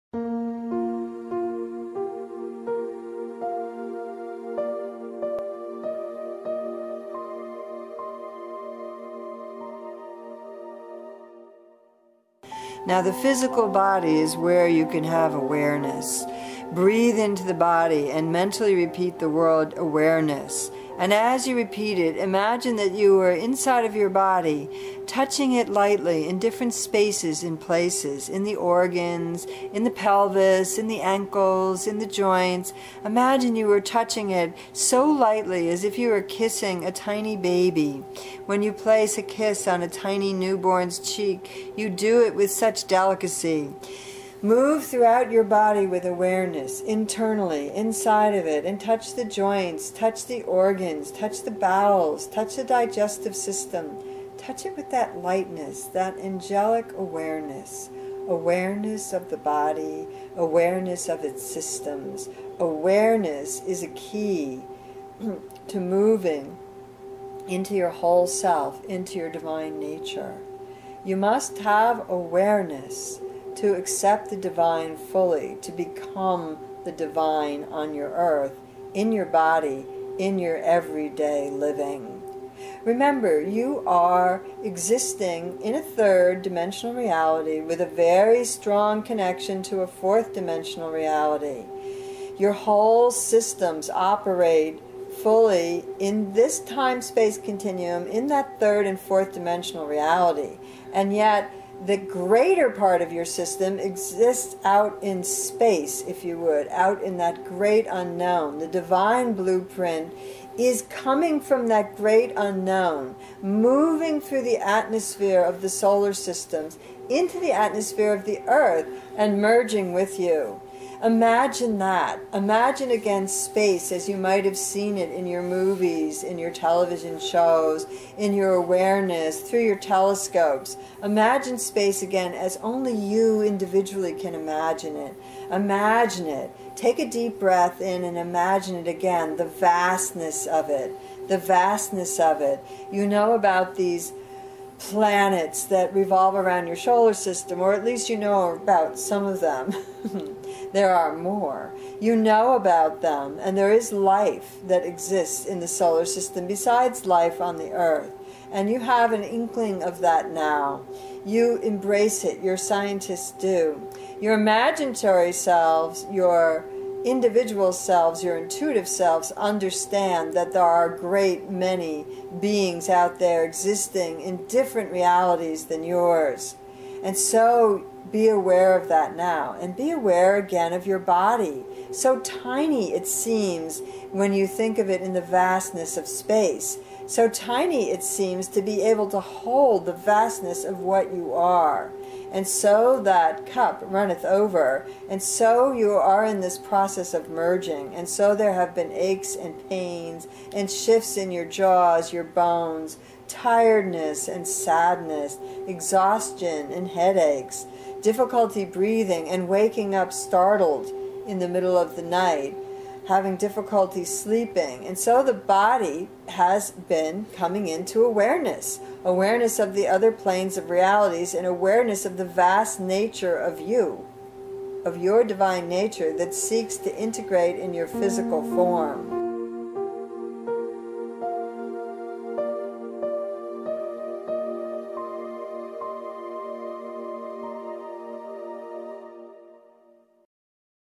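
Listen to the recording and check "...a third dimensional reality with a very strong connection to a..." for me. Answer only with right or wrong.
right.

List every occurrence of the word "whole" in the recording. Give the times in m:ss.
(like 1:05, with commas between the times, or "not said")
1:07, 1:32.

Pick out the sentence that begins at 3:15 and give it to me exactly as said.
And so you are in this process of merging.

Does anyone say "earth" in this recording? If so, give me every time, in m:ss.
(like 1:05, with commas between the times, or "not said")
1:18, 1:58, 2:37.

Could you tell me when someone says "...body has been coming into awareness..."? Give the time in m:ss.
3:35.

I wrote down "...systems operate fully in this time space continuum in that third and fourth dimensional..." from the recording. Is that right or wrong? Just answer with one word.
right.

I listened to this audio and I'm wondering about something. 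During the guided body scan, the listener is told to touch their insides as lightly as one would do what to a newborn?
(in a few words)
kissing a tiny baby.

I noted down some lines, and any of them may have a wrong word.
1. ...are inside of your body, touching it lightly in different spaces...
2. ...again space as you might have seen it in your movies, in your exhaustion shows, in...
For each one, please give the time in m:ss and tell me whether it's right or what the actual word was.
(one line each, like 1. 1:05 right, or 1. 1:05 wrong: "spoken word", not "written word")
1. 0:23 right
2. 2:02 wrong: "television", not "exhaustion".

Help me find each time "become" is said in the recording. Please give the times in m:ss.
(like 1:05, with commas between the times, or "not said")
1:15.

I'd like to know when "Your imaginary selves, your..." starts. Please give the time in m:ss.
2:44.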